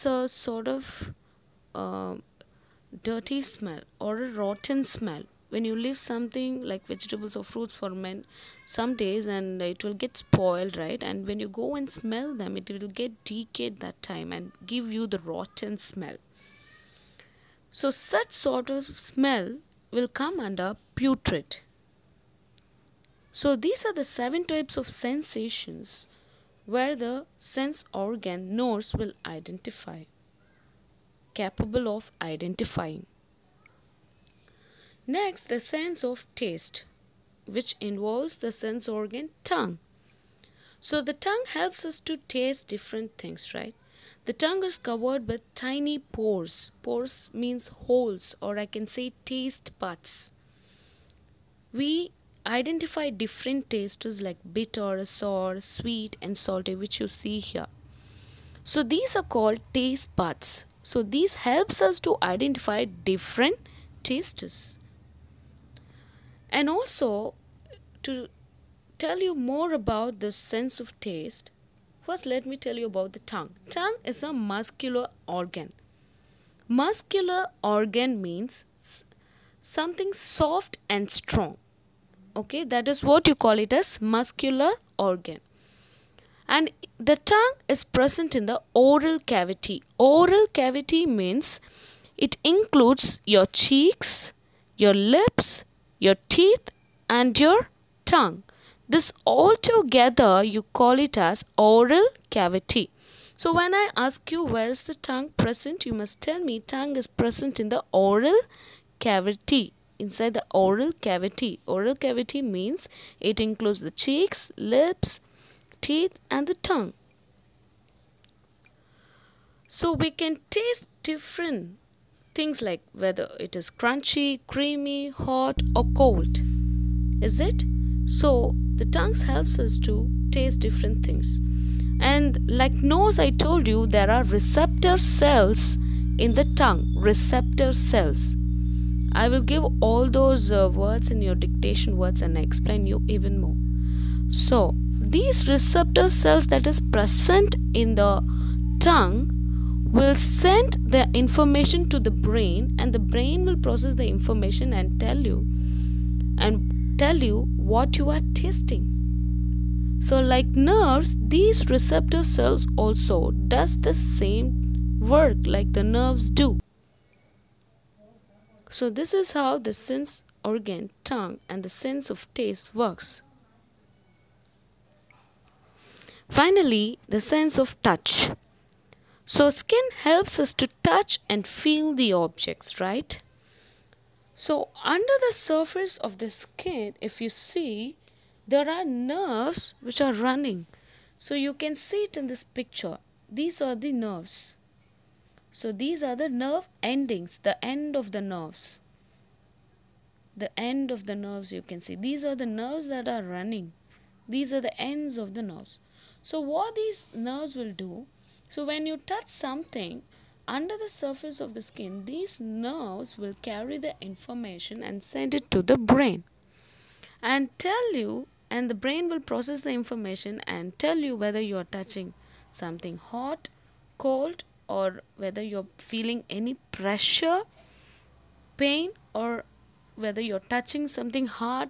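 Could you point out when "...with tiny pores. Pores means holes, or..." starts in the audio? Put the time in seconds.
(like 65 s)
45 s.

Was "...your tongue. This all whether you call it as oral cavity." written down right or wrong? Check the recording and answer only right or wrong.
wrong.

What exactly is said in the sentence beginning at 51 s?
We identify different tastes like bitter, sour, sweet, and salty, which you see here.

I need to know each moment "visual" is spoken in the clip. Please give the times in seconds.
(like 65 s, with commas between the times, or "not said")
not said.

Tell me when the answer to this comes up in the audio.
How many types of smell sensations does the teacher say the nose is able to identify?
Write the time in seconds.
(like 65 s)
24 s.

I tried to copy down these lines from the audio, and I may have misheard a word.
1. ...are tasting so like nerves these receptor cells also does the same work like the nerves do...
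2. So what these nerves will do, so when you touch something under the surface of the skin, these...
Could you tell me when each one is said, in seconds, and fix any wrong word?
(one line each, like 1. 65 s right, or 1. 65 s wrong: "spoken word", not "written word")
1. 158 s right
2. 206 s right.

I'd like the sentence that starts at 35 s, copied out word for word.
Next, the sense of taste, which involves the sense organ tongue.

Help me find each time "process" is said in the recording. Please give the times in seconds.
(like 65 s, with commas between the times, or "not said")
153 s, 219 s.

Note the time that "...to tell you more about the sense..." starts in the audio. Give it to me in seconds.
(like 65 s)
68 s.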